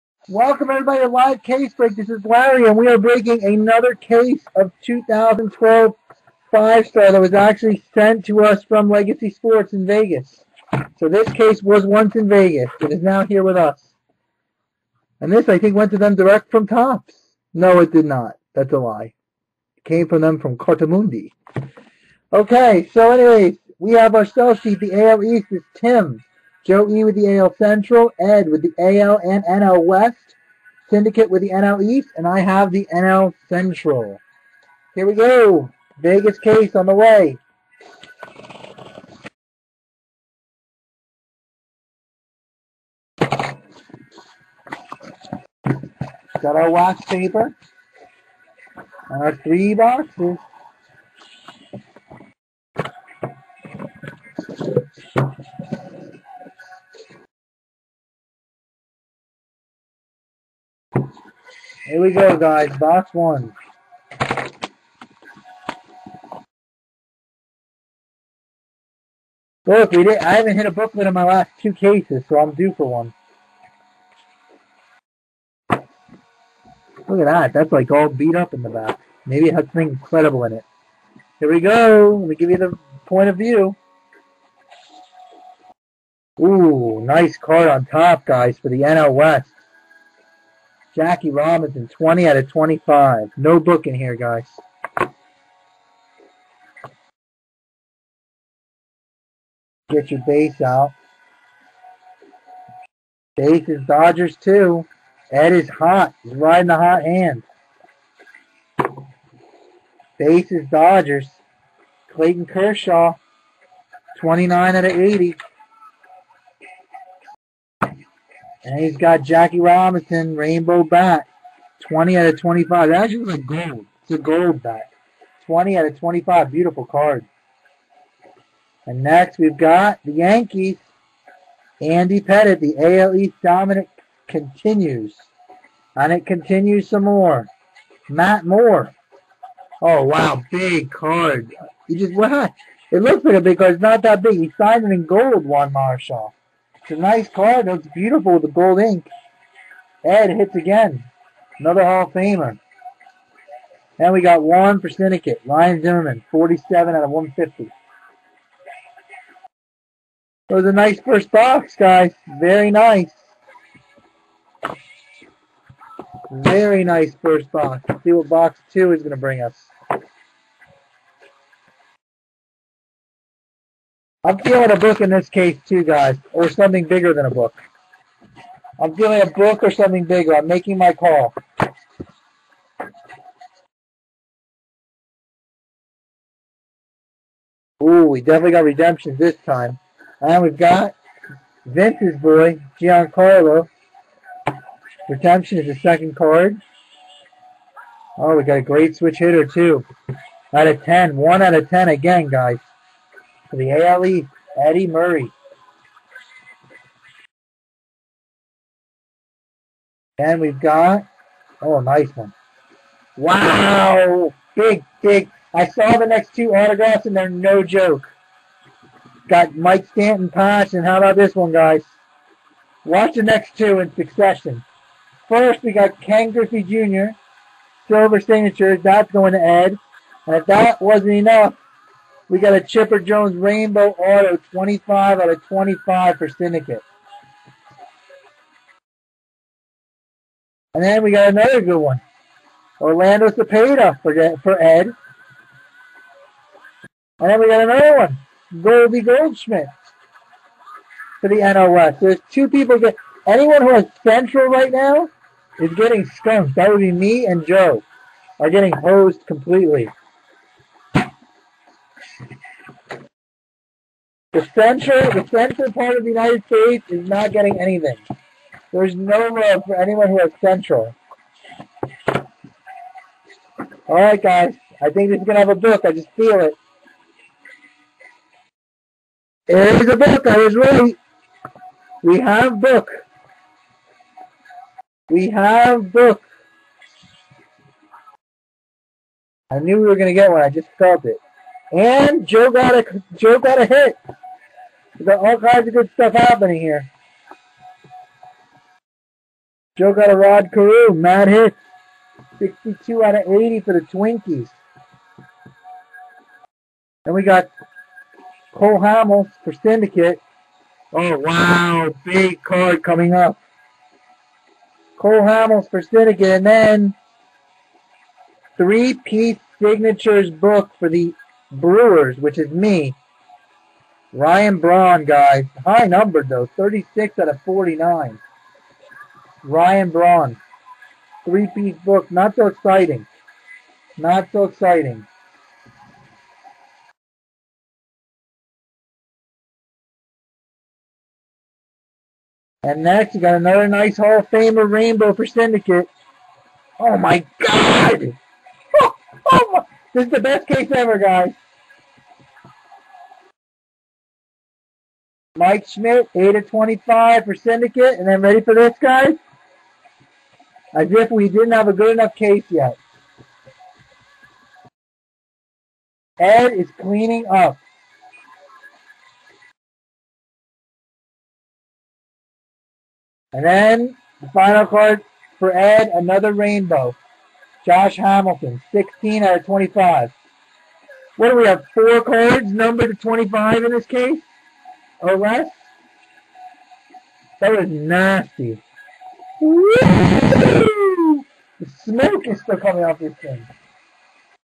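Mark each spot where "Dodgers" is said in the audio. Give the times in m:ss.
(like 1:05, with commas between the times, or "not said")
1:43, 1:50.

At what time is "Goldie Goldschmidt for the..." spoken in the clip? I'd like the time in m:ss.
4:08.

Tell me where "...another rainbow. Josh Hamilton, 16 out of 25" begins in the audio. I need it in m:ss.
6:15.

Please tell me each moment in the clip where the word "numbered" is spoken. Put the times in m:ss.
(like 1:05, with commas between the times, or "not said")
5:25, 6:22.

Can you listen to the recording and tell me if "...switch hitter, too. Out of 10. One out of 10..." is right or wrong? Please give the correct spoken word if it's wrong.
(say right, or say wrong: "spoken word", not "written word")
right.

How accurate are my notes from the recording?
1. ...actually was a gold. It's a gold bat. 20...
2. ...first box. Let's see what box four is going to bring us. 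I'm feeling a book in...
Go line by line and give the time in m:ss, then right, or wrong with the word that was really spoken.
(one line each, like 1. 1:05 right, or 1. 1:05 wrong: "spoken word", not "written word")
1. 2:03 right
2. 2:47 wrong: "two", not "four".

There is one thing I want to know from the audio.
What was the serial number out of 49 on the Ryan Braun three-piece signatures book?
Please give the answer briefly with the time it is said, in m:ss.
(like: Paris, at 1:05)
36, at 5:26.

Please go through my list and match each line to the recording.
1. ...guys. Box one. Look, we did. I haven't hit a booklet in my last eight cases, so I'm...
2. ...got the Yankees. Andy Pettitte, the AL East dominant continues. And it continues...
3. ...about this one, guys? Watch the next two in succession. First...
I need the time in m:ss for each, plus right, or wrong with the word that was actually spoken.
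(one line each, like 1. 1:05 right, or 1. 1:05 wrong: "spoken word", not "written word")
1. 1:02 wrong: "two", not "eight"
2. 2:09 right
3. 3:40 right.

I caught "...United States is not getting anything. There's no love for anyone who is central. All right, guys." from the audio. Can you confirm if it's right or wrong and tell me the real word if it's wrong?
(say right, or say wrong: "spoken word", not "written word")
right.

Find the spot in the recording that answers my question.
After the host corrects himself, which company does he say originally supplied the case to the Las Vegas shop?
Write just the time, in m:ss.
0:20.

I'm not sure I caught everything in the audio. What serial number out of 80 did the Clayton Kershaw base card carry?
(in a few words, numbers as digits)
29.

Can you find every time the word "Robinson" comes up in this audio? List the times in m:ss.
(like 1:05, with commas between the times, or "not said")
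1:31, 1:59.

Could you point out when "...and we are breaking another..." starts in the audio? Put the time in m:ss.
0:02.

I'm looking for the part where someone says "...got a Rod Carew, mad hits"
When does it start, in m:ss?
4:59.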